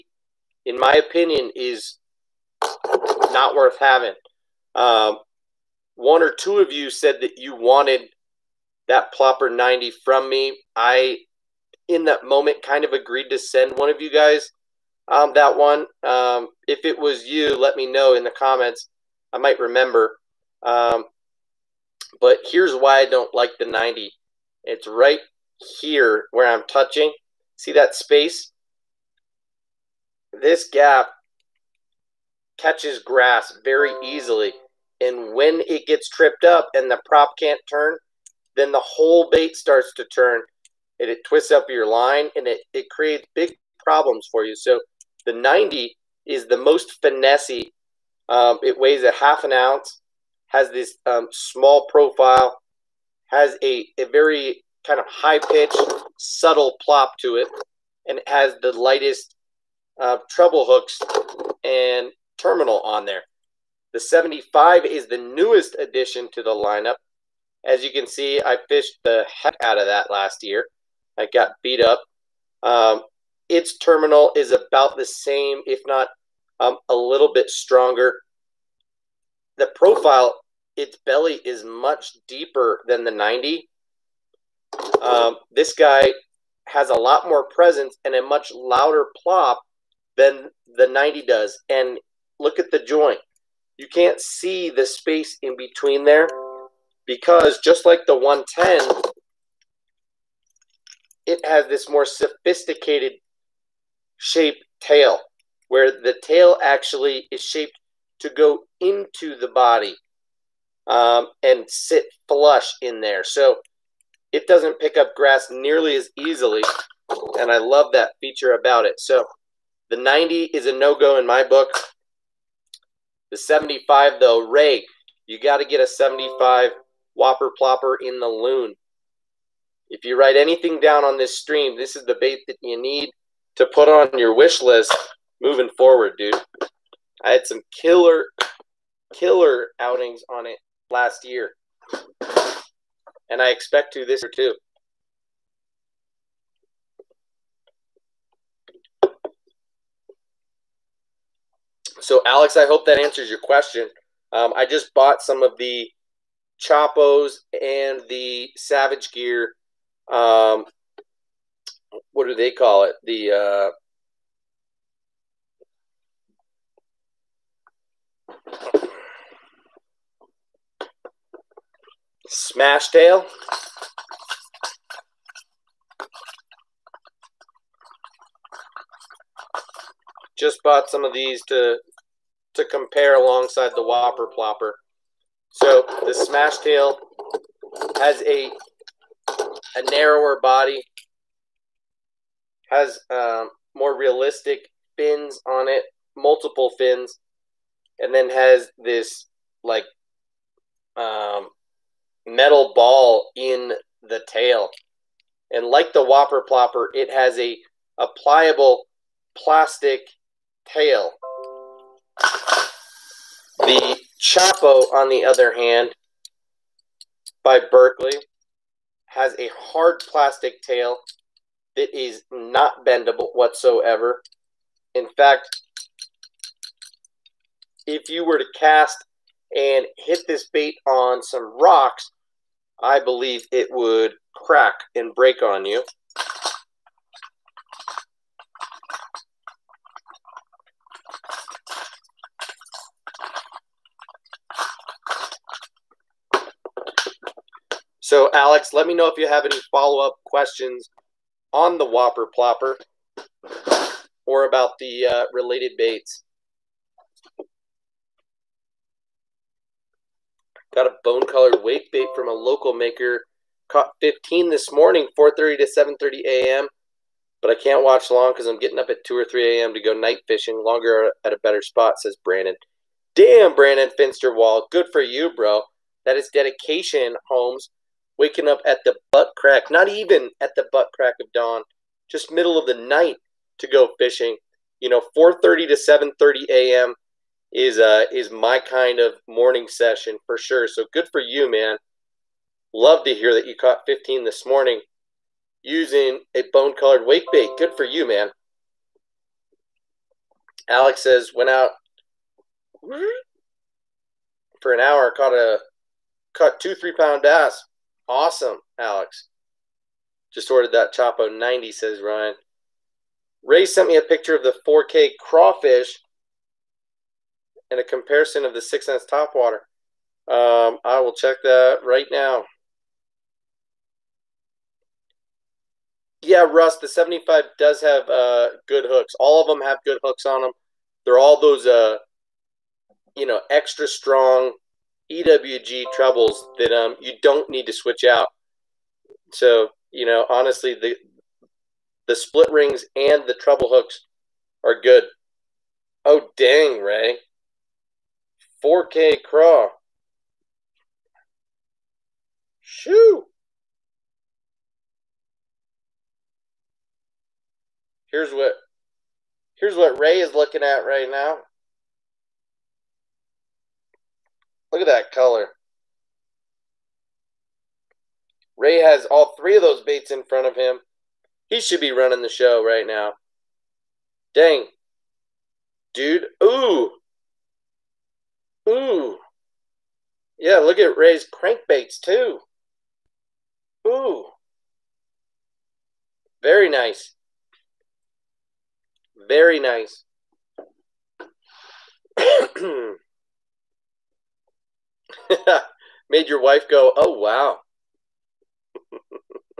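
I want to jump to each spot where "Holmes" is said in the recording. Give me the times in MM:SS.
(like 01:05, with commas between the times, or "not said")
04:37.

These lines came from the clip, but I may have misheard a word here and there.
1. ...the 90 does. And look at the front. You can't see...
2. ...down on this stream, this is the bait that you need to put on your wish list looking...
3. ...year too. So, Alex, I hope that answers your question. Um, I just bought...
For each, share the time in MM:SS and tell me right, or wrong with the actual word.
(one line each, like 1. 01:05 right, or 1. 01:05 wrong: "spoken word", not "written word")
1. 01:30 wrong: "joint", not "front"
2. 02:10 wrong: "moving", not "looking"
3. 02:24 right.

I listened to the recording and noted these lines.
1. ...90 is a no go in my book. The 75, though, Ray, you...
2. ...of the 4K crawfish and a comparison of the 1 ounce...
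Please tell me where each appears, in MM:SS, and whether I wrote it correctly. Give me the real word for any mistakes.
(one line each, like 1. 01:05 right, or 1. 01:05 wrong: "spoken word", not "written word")
1. 01:59 right
2. 05:14 wrong: "6", not "1".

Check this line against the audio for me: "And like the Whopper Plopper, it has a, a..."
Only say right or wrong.
right.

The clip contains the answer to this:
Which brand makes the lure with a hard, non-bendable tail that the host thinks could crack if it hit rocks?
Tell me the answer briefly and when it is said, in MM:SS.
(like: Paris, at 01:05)
Berkley, at 03:37.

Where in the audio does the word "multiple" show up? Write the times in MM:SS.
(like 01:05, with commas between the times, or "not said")
03:16.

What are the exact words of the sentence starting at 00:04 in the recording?
Um, one or two of you said that you wanted that plopper 90 from me.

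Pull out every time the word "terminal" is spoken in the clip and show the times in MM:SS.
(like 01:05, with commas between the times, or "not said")
01:02, 01:13.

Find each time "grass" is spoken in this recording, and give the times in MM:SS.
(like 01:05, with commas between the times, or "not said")
00:32, 01:55.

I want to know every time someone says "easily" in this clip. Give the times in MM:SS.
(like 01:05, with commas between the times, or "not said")
00:34, 01:56.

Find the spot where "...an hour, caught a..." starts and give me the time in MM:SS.
05:04.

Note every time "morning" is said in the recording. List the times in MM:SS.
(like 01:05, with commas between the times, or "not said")
04:24, 04:49, 04:54.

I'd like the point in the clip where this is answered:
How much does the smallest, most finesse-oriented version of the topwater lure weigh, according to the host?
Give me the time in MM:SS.
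00:49.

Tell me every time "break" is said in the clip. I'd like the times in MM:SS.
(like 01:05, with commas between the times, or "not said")
03:55.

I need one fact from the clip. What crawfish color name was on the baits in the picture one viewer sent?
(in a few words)
4K craw.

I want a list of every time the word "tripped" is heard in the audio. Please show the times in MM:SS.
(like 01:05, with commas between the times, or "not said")
00:36.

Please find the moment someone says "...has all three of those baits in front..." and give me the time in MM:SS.
06:08.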